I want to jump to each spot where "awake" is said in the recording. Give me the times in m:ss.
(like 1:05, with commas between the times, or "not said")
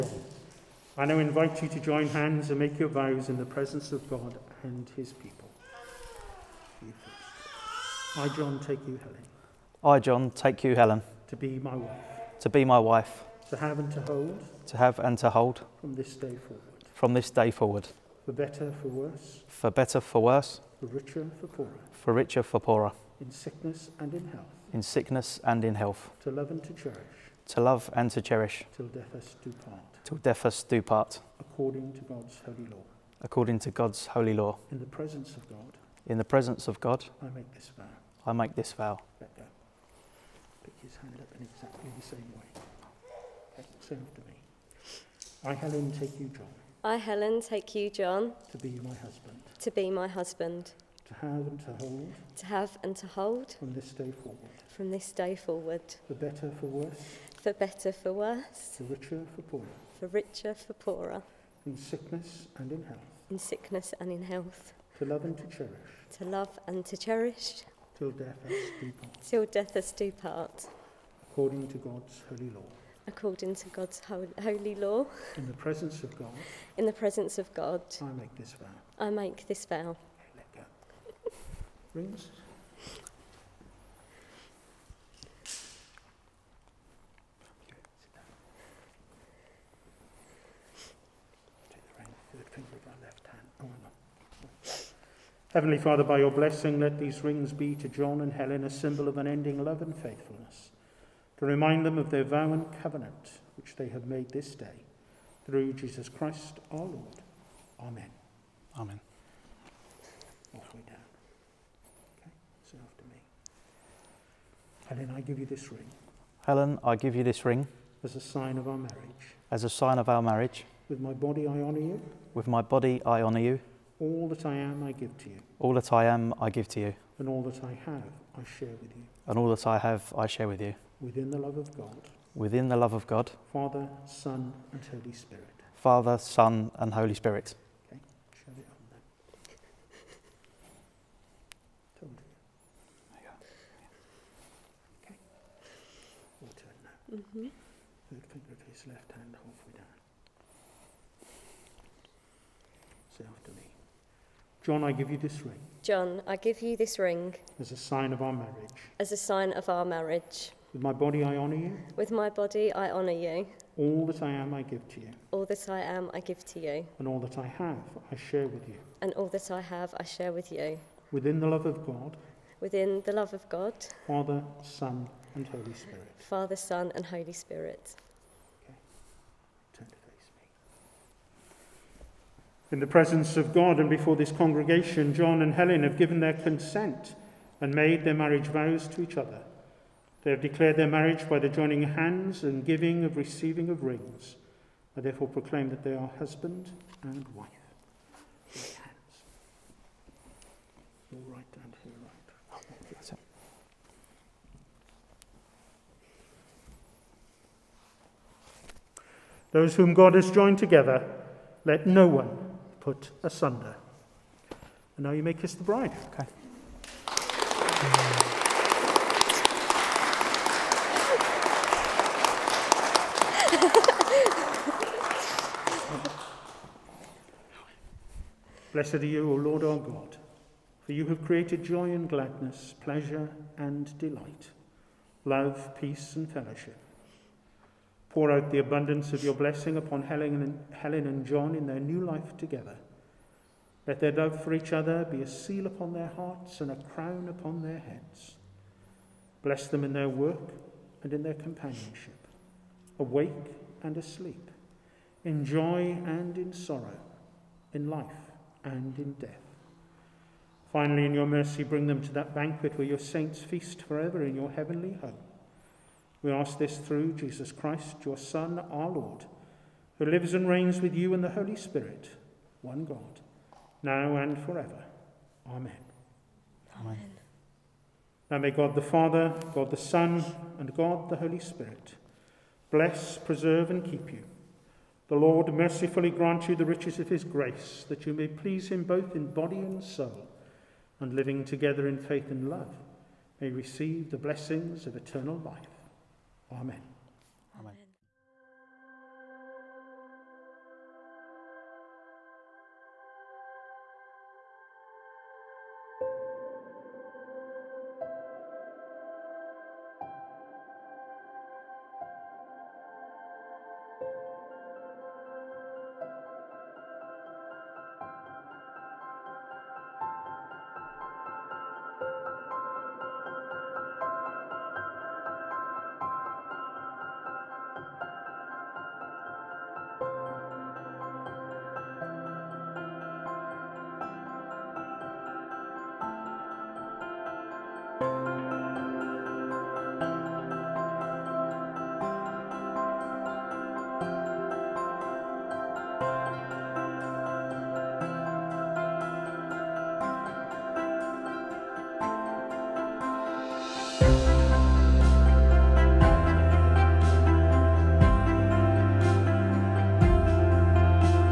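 4:12.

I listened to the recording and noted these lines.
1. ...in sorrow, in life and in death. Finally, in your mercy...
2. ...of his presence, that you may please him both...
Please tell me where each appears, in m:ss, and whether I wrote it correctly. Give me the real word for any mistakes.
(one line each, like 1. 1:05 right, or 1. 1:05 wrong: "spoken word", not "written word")
1. 4:16 right
2. 4:47 wrong: "grace", not "presence".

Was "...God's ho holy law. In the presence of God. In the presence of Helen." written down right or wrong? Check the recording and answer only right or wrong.
wrong.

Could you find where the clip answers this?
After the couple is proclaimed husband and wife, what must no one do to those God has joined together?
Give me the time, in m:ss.
3:32.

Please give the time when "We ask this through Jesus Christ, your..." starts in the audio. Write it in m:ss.
4:26.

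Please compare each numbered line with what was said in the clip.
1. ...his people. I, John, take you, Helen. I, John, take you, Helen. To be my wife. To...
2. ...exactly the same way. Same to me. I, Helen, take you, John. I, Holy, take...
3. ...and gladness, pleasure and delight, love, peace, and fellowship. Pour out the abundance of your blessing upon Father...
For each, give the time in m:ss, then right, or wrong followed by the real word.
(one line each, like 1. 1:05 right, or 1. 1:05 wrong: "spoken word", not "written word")
1. 0:04 right
2. 0:41 wrong: "Helen", not "Holy"
3. 3:51 wrong: "Helen", not "Father".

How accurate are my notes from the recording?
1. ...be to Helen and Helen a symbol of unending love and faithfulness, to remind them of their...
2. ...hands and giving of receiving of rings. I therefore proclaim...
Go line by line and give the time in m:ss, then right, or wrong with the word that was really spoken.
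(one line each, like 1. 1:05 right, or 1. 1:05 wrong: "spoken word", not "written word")
1. 1:37 wrong: "John", not "Helen"
2. 3:11 right.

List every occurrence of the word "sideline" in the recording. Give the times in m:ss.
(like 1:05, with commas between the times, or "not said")
not said.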